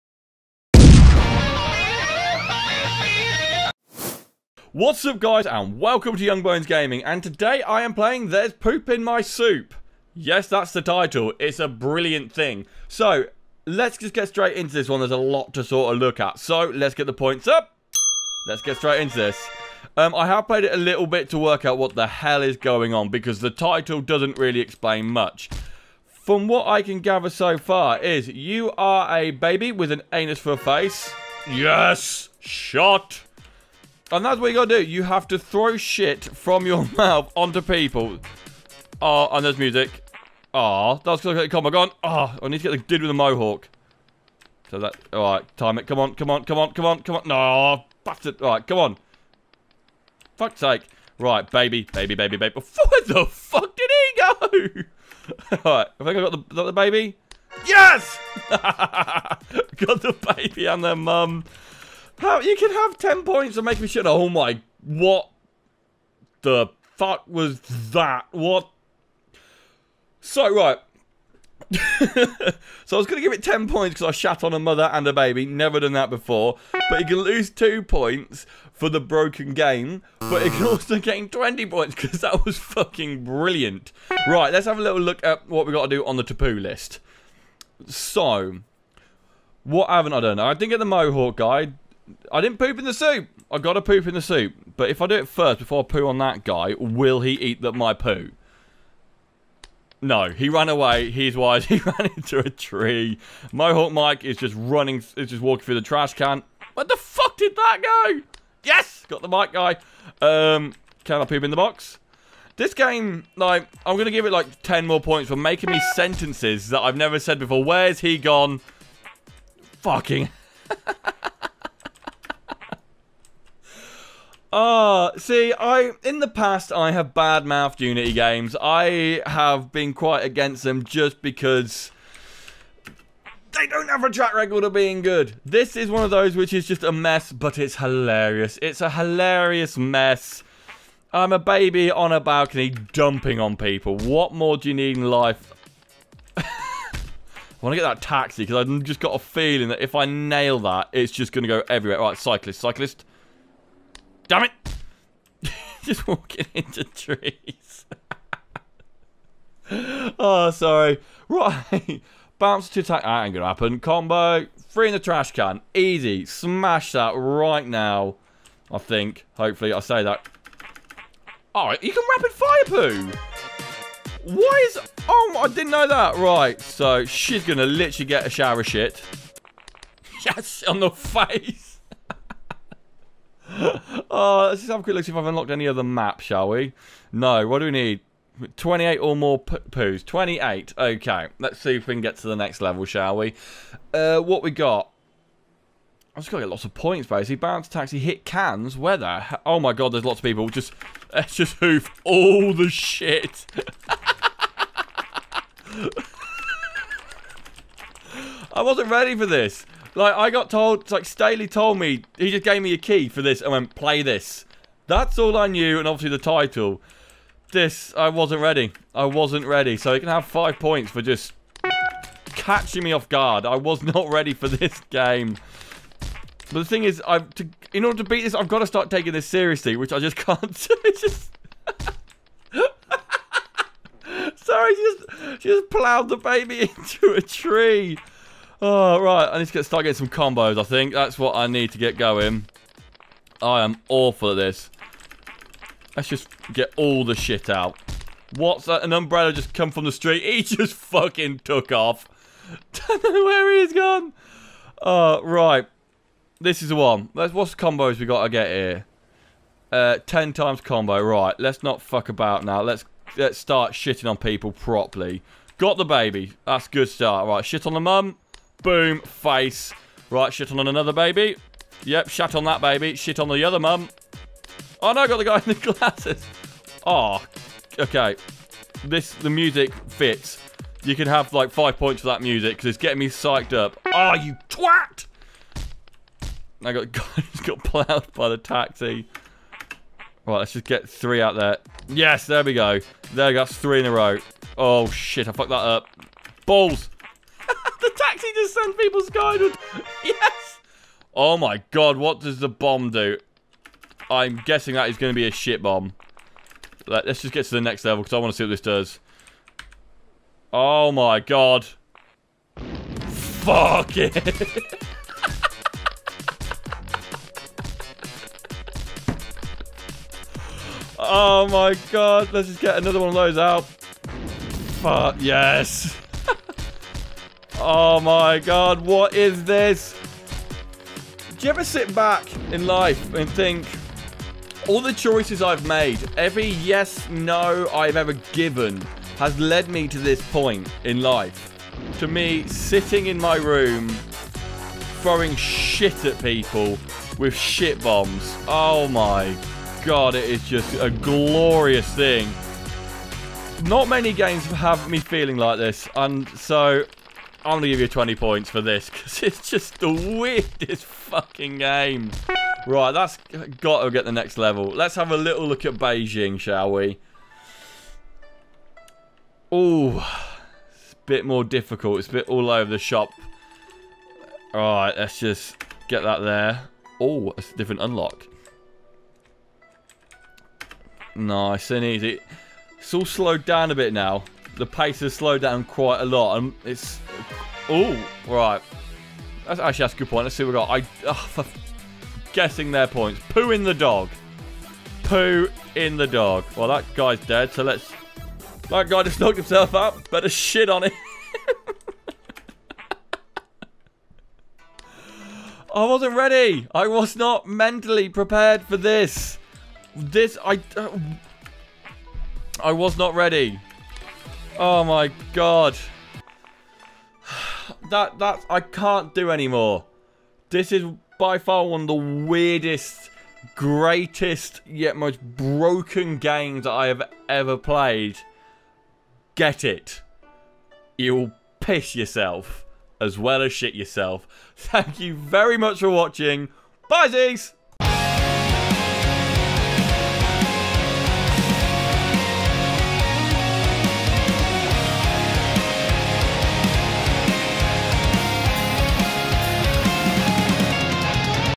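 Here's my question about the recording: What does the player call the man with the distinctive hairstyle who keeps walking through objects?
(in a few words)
Mohawk Mike.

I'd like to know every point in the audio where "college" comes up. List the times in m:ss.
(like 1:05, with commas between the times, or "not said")
not said.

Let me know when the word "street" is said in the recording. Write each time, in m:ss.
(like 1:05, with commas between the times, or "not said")
4:09.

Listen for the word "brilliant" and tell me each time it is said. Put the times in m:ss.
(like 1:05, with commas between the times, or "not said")
0:11, 1:23.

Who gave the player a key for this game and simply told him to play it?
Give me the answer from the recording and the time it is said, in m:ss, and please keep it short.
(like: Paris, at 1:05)
Staley, at 3:31.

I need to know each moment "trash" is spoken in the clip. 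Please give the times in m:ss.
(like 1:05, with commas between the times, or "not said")
1:45, 2:45.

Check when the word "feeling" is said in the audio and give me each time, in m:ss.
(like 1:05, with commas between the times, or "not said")
2:29, 5:54.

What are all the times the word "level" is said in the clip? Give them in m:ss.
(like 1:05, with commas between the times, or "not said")
3:12, 5:07, 6:04.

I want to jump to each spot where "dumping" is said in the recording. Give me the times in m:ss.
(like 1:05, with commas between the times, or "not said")
2:22.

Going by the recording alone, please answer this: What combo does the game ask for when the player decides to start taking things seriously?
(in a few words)
10 times.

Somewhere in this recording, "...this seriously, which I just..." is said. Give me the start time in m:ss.
3:49.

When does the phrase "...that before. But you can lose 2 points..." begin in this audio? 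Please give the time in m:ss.
1:15.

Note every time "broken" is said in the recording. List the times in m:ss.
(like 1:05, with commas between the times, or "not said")
1:18, 7:05.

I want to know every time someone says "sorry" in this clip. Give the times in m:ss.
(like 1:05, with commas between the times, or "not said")
2:40, 3:54.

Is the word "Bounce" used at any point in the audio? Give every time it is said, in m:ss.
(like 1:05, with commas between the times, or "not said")
2:42, 3:17.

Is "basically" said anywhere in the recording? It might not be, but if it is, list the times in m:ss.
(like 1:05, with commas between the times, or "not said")
3:17.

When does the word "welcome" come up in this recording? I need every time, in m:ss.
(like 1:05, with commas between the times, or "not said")
0:05.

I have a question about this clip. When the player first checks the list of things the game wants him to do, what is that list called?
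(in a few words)
taboo list.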